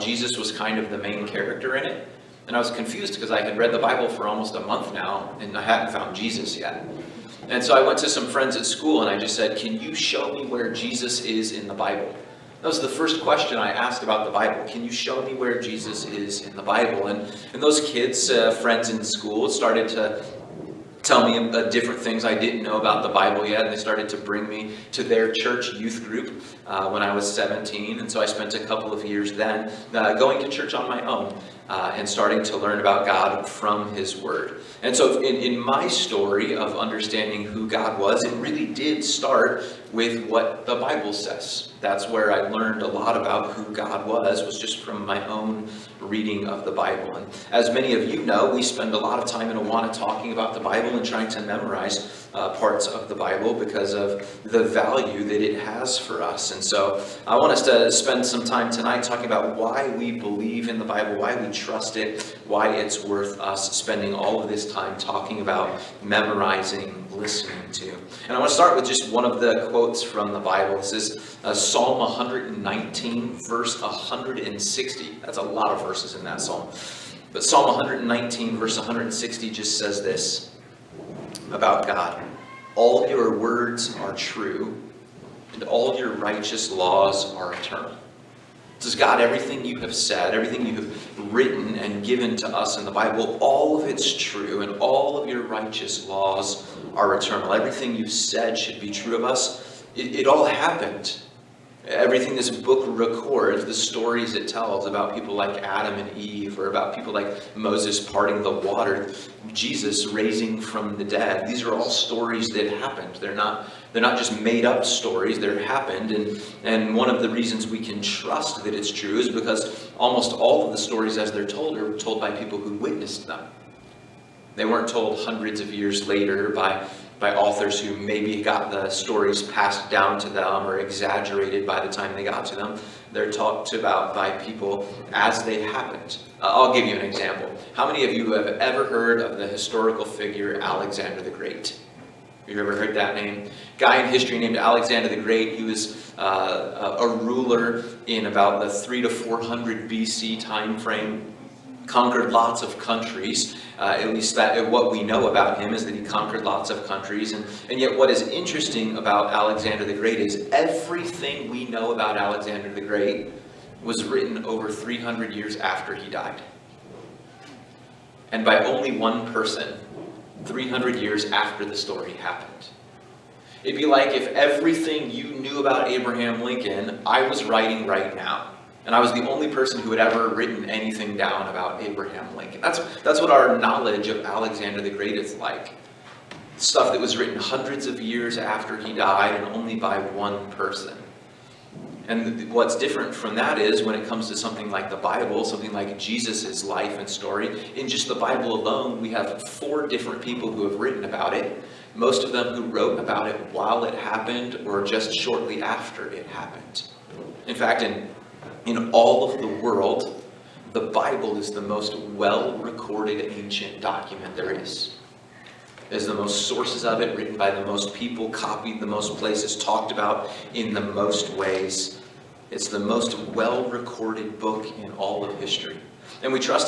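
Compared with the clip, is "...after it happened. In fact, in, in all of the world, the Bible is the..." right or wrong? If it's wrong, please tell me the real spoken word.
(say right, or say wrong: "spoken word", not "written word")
right.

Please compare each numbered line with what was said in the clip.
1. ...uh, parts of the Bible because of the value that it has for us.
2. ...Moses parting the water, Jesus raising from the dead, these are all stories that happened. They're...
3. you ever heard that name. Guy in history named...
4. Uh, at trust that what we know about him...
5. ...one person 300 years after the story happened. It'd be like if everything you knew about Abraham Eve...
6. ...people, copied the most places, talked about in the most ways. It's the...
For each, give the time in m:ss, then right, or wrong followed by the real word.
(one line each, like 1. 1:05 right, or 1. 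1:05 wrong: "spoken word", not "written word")
1. 0:52 right
2. 1:47 right
3. 2:22 right
4. 2:33 wrong: "least", not "trust"
5. 2:48 wrong: "Lincoln", not "Eve"
6. 3:37 right.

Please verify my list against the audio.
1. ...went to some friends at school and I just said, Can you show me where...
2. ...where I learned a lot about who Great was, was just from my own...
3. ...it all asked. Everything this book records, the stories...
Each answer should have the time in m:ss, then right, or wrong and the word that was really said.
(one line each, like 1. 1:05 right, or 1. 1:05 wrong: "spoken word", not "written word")
1. 0:07 right
2. 0:42 wrong: "God", not "Great"
3. 1:40 wrong: "happened", not "asked".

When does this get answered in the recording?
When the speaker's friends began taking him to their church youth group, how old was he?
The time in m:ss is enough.
0:27.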